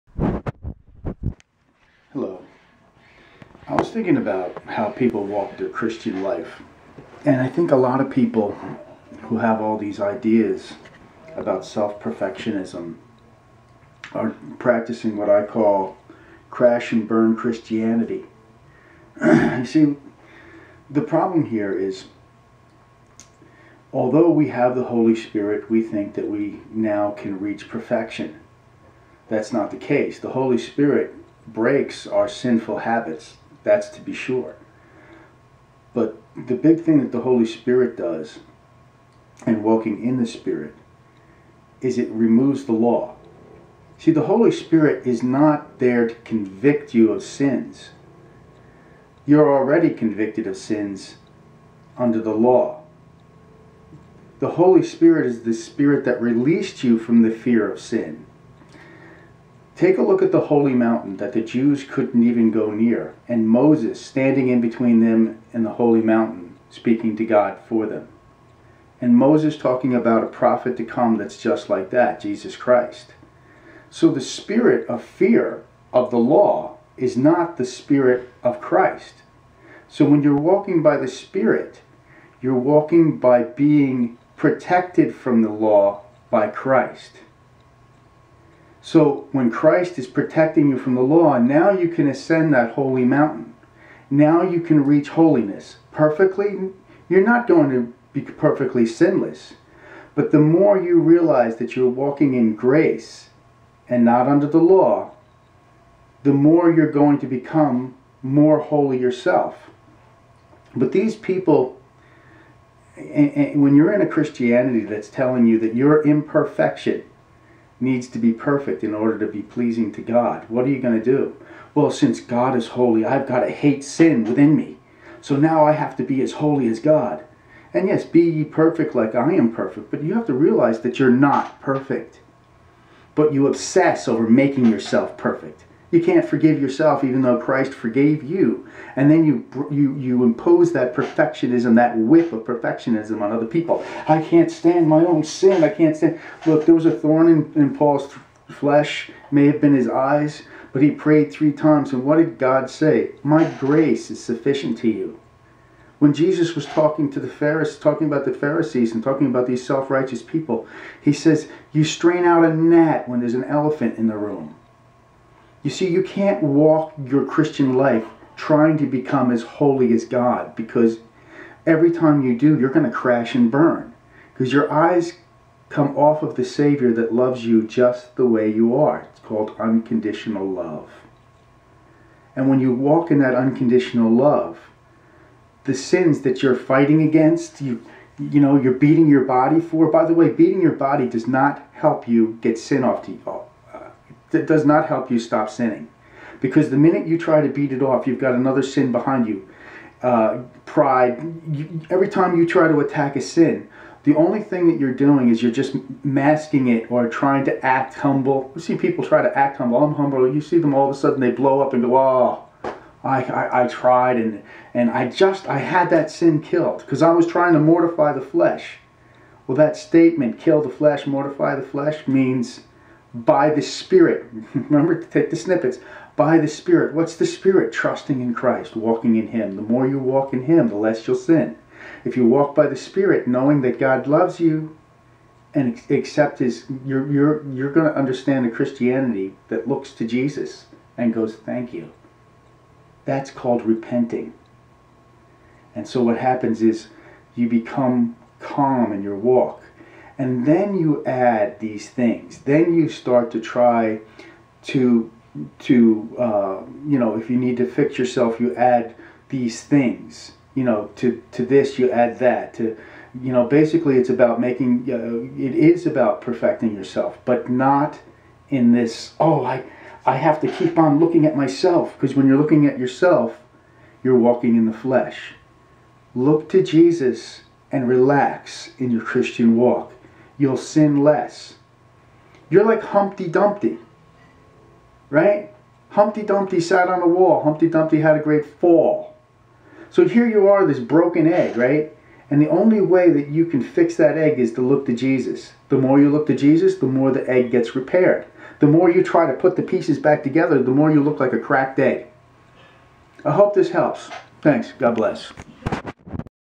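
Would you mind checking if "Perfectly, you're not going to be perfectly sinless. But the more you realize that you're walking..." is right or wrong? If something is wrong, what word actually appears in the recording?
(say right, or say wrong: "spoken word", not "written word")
right.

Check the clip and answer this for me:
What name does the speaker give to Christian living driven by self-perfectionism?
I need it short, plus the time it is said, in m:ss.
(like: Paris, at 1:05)
crash and burn Christianity, at 0:16.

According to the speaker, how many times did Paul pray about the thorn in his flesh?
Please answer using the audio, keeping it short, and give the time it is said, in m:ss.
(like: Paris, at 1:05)
3, at 2:31.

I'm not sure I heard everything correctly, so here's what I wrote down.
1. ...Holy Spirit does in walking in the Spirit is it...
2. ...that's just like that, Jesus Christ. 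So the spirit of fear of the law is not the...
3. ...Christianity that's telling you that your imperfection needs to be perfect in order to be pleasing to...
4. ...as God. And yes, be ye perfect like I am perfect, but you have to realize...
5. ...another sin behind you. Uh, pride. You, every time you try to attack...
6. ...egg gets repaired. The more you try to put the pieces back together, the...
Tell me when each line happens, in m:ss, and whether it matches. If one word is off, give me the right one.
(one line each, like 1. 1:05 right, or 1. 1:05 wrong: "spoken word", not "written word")
1. 0:37 right
2. 1:11 right
3. 1:54 right
4. 2:06 right
5. 3:18 right
6. 4:57 right.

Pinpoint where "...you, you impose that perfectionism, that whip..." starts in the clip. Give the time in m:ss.
2:19.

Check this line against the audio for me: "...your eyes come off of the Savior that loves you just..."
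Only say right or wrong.
right.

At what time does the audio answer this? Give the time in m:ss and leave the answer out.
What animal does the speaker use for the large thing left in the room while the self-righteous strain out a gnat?
2:43.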